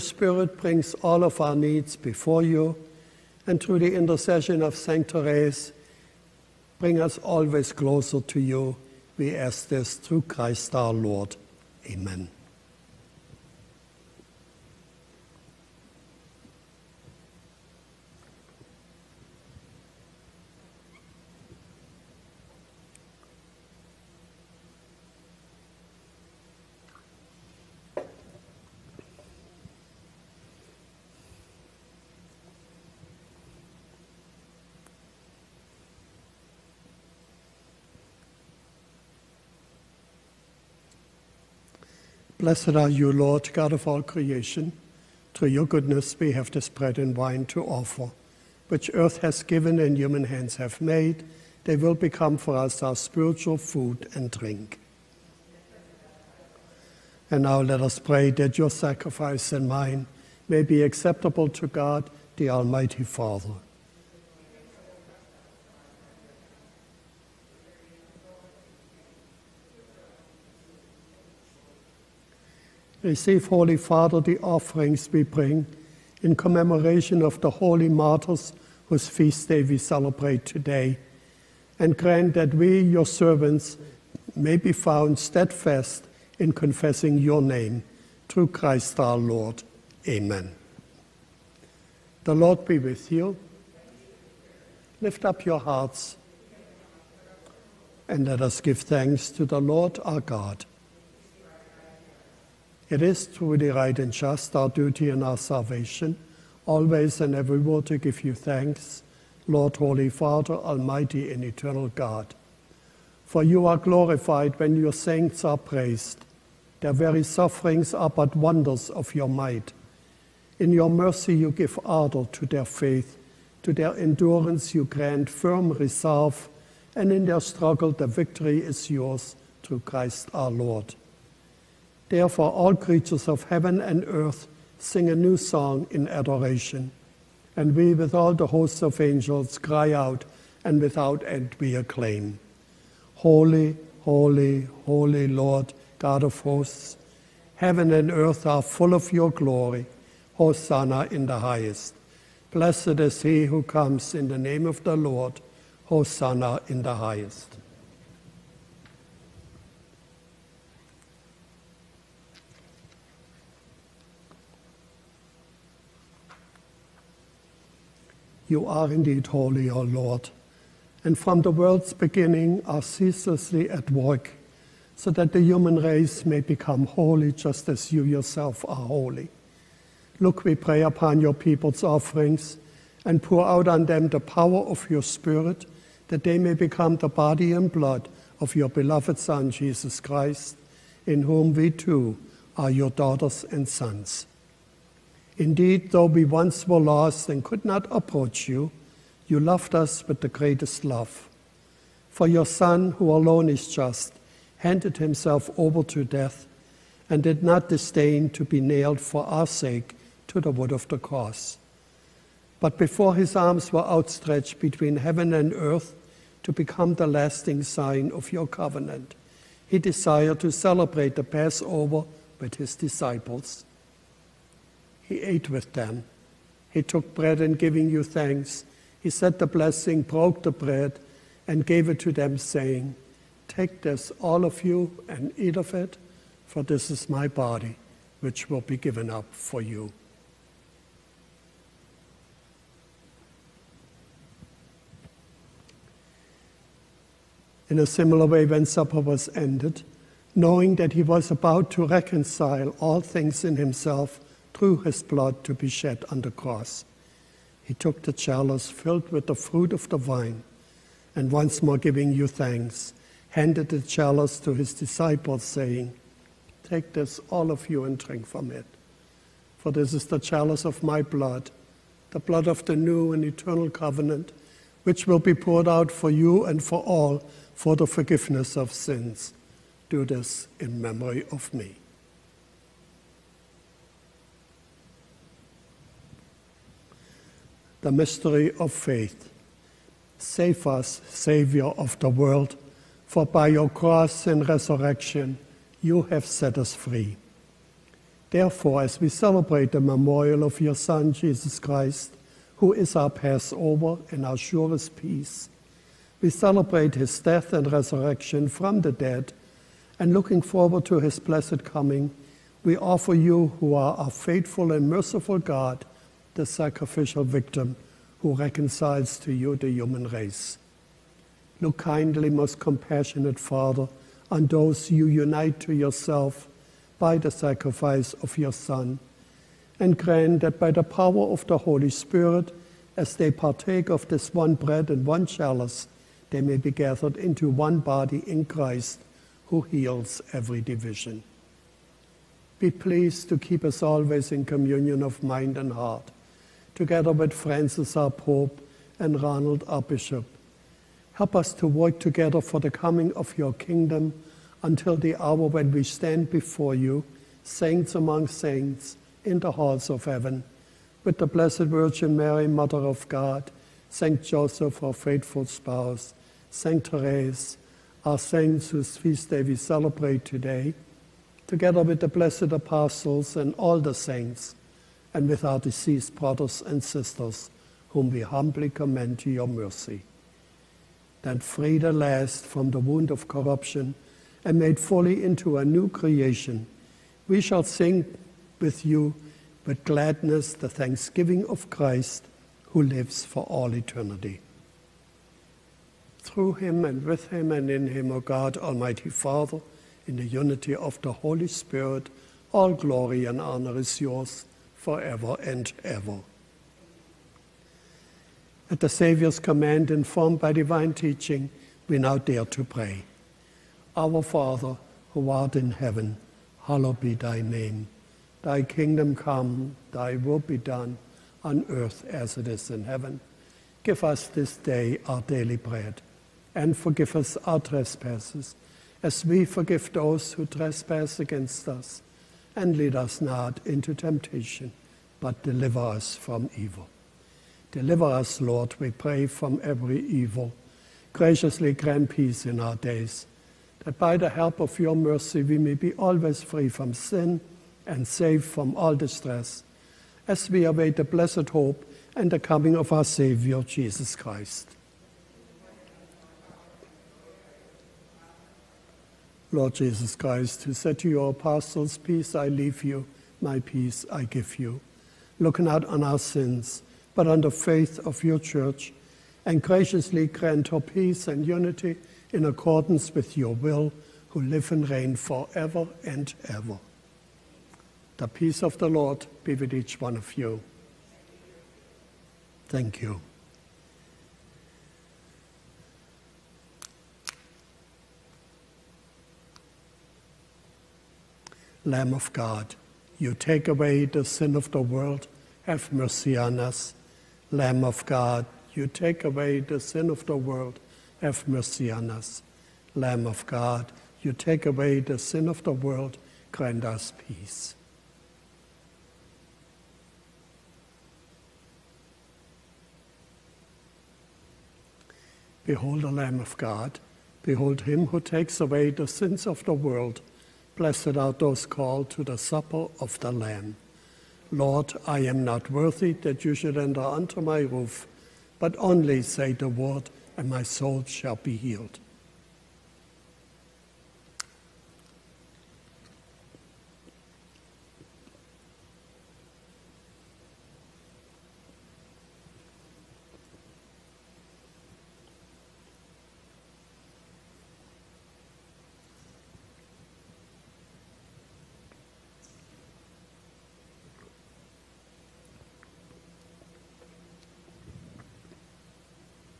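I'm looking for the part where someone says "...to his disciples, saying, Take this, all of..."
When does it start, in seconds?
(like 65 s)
264 s.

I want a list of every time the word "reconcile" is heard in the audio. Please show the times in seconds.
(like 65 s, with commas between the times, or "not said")
251 s, 318 s.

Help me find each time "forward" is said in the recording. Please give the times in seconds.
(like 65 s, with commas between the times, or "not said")
310 s.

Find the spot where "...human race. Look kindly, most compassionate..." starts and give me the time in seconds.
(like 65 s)
319 s.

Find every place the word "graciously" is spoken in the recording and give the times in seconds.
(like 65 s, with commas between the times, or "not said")
441 s, 469 s.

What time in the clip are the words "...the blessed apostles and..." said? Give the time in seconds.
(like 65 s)
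371 s.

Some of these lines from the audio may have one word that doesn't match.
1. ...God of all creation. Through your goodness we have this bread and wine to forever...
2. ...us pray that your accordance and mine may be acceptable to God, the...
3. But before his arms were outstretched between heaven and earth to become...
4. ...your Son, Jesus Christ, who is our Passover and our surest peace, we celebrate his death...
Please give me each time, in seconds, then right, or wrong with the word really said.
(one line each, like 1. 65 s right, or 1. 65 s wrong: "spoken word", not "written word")
1. 43 s wrong: "offer", not "forever"
2. 57 s wrong: "sacrifice", not "accordance"
3. 212 s right
4. 300 s right.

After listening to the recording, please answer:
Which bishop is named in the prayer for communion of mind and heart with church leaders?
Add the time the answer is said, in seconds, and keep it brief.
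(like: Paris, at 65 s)
Ronald, at 349 s.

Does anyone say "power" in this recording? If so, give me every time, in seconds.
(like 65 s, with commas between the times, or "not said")
184 s, 330 s.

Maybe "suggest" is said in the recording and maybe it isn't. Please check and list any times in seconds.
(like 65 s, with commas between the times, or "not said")
not said.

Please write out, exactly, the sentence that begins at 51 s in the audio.
They will become for us our spiritual food and drink.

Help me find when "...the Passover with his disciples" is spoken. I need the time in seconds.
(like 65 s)
221 s.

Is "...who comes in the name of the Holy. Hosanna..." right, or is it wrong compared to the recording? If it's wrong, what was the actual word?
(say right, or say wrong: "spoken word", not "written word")
wrong: "Lord", not "Holy".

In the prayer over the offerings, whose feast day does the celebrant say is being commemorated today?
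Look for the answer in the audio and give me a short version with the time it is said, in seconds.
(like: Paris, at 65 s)
The holy martyrs, at 77 s.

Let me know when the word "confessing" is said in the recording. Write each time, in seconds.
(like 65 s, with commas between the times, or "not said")
86 s.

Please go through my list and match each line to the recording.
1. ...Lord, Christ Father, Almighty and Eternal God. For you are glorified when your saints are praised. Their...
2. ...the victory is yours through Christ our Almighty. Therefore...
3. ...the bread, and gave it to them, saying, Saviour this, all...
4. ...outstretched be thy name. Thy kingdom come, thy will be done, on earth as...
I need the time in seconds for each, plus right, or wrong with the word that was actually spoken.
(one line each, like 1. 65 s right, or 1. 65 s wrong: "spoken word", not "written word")
1. 109 s wrong: "Holy", not "Christ"
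2. 127 s wrong: "Lord", not "Almighty"
3. 230 s wrong: "Take", not "Saviour"
4. 416 s wrong: "hallowed", not "outstretched".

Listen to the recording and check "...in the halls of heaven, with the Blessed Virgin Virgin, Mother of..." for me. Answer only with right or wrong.
wrong.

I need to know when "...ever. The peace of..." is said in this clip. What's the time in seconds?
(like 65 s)
476 s.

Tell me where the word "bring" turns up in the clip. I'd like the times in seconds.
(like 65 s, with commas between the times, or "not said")
0 s, 6 s, 75 s.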